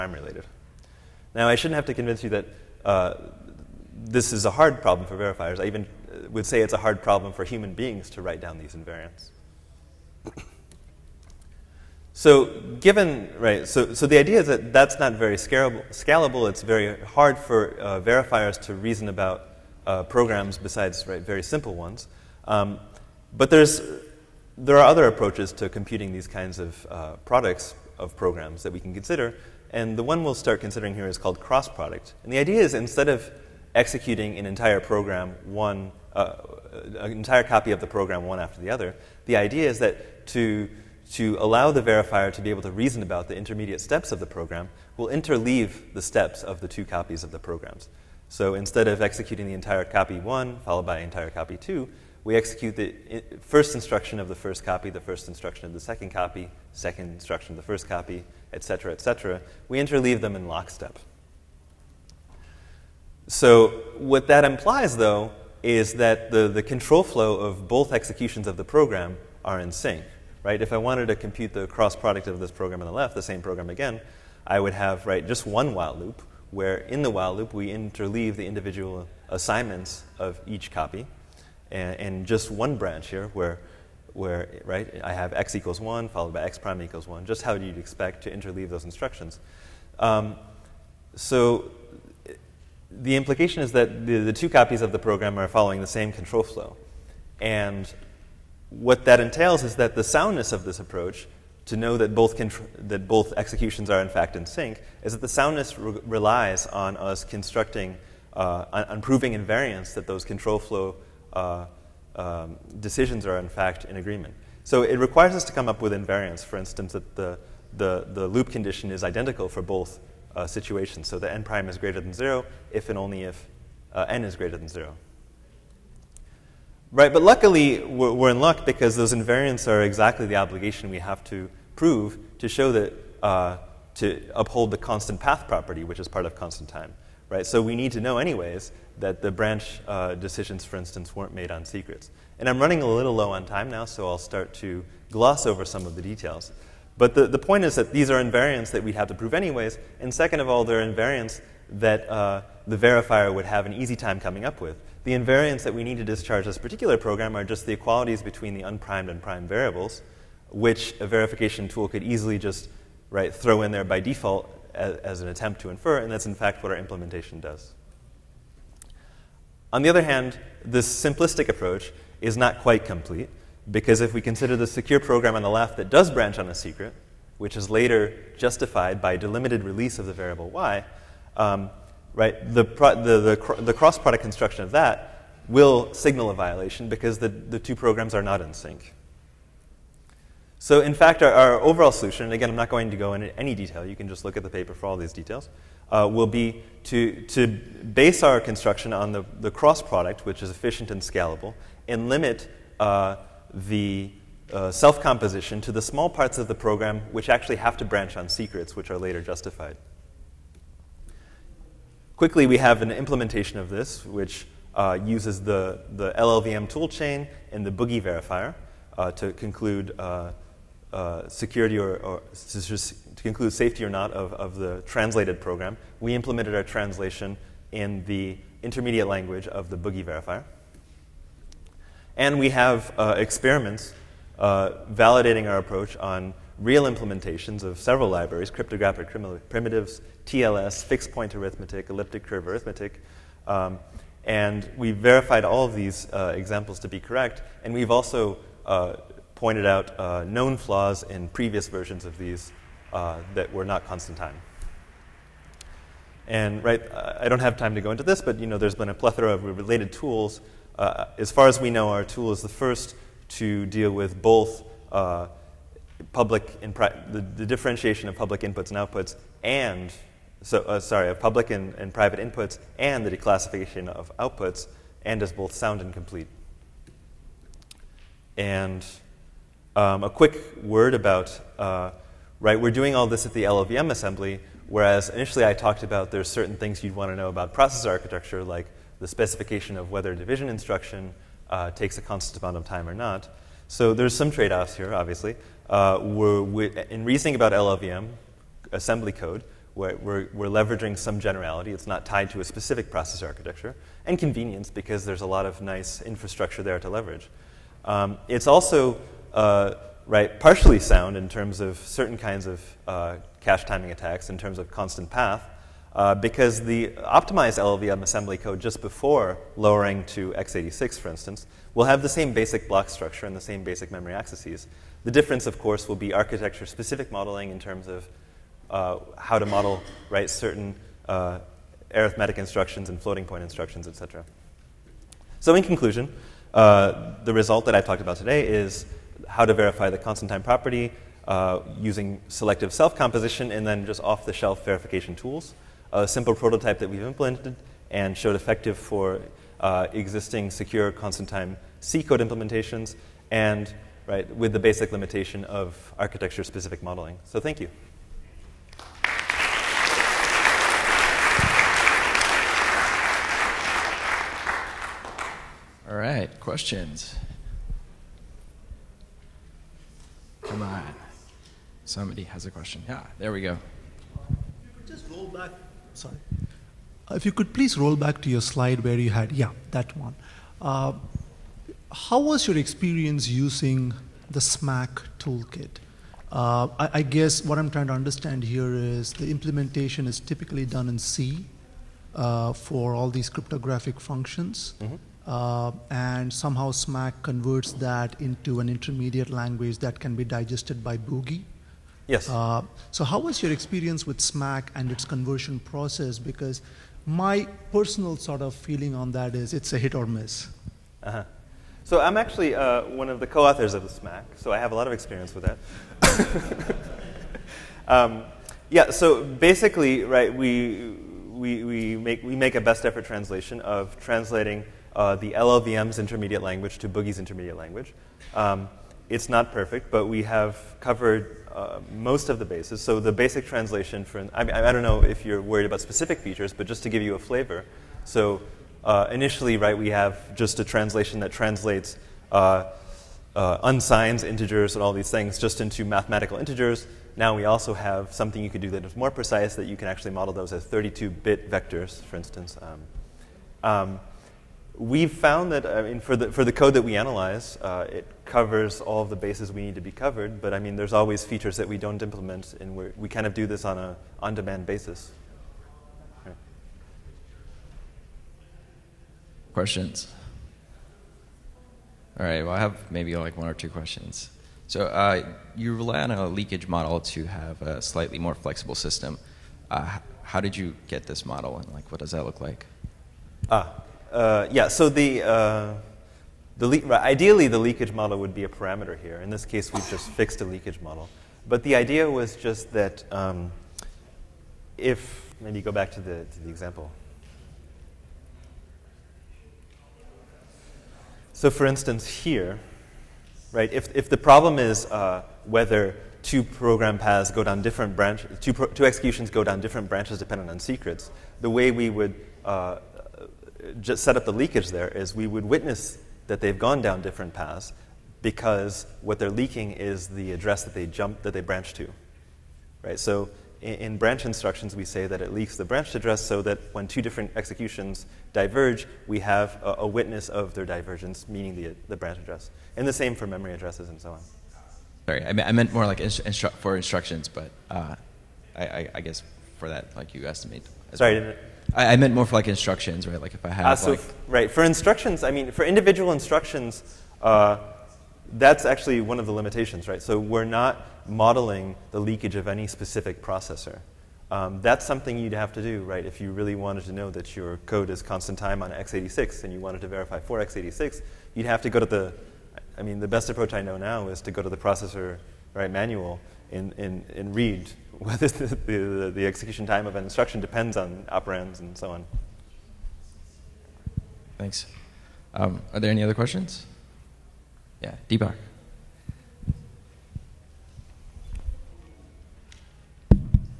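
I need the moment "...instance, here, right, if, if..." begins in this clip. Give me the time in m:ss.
8:21.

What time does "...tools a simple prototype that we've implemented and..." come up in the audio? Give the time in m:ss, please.
5:45.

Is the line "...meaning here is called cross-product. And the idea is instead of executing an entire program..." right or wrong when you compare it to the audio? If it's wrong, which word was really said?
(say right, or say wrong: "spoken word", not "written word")
wrong: "considering", not "meaning".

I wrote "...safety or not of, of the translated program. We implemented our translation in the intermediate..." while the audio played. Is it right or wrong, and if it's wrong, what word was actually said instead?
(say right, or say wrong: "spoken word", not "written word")
right.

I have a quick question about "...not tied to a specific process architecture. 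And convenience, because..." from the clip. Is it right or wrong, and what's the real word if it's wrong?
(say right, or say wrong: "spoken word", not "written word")
right.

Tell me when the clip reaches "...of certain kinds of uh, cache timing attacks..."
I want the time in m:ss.
5:11.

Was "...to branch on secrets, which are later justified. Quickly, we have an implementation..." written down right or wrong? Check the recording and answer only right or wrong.
right.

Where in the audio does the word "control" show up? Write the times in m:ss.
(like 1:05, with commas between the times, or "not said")
1:06, 1:36, 1:50.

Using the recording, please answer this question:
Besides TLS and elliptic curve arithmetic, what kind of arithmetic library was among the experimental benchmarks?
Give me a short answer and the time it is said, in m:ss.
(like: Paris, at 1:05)
fixed point arithmetic, at 4:00.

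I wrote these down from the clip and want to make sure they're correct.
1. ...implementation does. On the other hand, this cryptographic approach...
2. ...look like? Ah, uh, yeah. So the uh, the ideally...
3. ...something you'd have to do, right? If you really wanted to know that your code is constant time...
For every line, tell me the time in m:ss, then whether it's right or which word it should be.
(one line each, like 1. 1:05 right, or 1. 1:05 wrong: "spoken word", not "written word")
1. 2:46 wrong: "simplistic", not "cryptographic"
2. 8:02 right
3. 9:14 right.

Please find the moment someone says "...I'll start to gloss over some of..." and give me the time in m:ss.
2:24.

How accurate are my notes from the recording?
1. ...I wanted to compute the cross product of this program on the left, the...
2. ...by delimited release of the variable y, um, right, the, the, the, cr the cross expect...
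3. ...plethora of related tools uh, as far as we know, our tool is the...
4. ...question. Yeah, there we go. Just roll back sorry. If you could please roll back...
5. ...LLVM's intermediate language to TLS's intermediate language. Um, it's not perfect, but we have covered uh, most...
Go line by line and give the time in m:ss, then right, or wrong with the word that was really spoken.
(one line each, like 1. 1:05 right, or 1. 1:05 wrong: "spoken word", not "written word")
1. 1:10 right
2. 2:59 wrong: "product", not "expect"
3. 4:18 right
4. 6:12 right
5. 7:05 wrong: "Boogie", not "TLS".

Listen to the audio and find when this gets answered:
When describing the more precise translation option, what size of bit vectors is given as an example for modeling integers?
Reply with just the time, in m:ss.
7:30.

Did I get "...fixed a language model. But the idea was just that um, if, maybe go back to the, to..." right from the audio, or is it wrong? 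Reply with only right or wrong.
wrong.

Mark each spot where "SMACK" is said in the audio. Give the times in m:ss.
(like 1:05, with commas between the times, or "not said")
6:24, 6:36, 6:44, 6:53.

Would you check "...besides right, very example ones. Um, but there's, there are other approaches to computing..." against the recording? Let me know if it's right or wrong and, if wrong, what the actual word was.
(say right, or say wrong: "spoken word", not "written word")
wrong: "simple", not "example".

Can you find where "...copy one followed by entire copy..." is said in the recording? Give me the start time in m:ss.
0:49.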